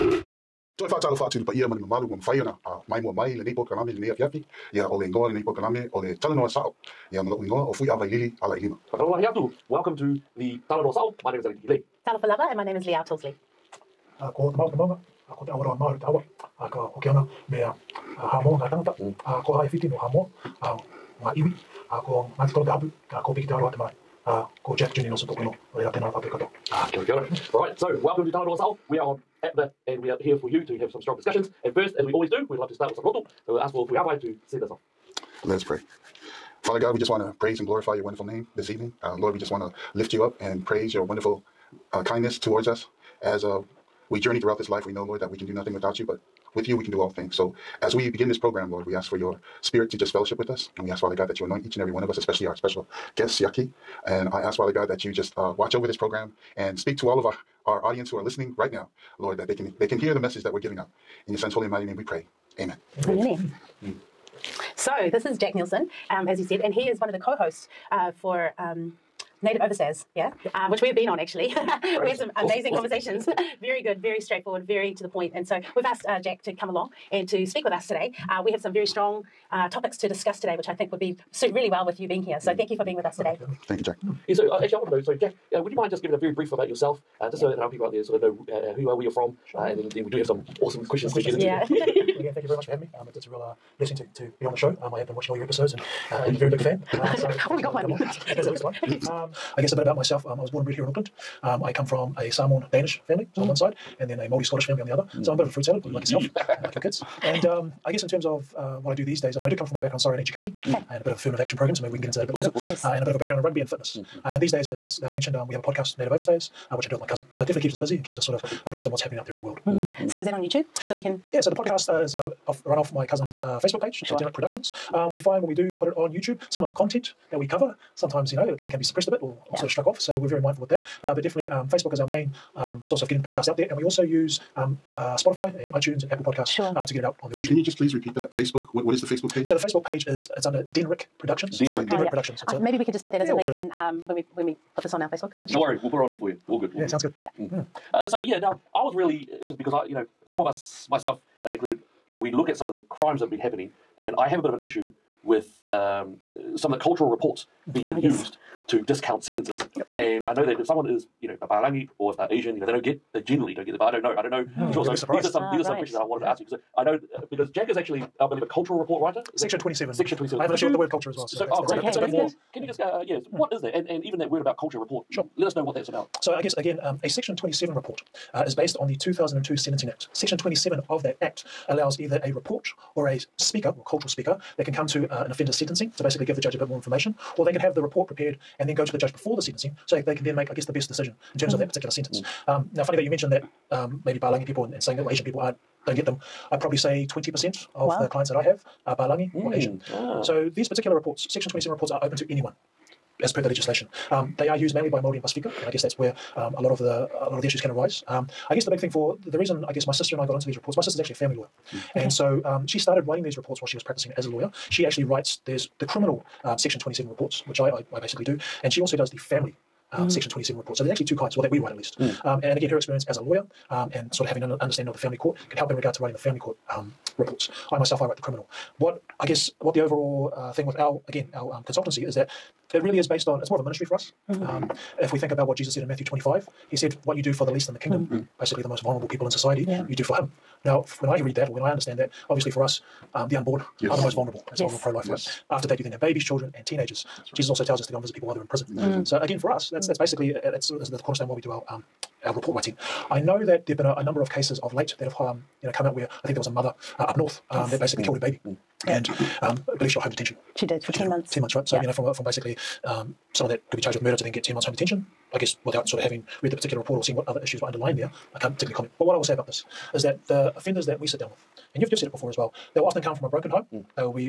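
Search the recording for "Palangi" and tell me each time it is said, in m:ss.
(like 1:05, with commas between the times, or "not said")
2:41, 3:14, 3:18.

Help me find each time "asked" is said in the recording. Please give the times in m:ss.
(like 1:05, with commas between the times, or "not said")
1:15.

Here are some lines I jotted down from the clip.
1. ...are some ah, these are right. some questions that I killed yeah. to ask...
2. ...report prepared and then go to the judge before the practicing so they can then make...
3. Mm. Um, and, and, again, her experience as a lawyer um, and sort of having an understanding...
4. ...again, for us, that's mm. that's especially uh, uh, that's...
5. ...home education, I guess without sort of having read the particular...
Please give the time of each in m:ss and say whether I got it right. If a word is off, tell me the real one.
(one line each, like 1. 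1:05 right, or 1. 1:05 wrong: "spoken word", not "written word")
1. 2:45 wrong: "wanted", not "killed"
2. 3:07 wrong: "sentencing", not "practicing"
3. 3:41 right
4. 4:09 wrong: "basically", not "especially"
5. 4:24 wrong: "detention", not "education".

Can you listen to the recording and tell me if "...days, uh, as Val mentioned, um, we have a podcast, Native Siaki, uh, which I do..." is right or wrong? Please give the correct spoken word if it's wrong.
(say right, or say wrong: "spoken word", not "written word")
wrong: "Overstayers", not "Siaki".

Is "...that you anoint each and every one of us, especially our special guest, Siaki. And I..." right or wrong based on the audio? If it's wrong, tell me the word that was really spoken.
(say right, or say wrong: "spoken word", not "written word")
right.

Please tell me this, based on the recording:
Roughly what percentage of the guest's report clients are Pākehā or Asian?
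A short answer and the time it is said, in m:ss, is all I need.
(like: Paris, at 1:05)
20%, at 3:17.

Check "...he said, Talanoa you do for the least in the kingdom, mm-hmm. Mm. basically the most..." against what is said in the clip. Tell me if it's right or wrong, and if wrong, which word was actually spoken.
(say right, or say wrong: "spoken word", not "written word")
wrong: "What", not "Talanoa".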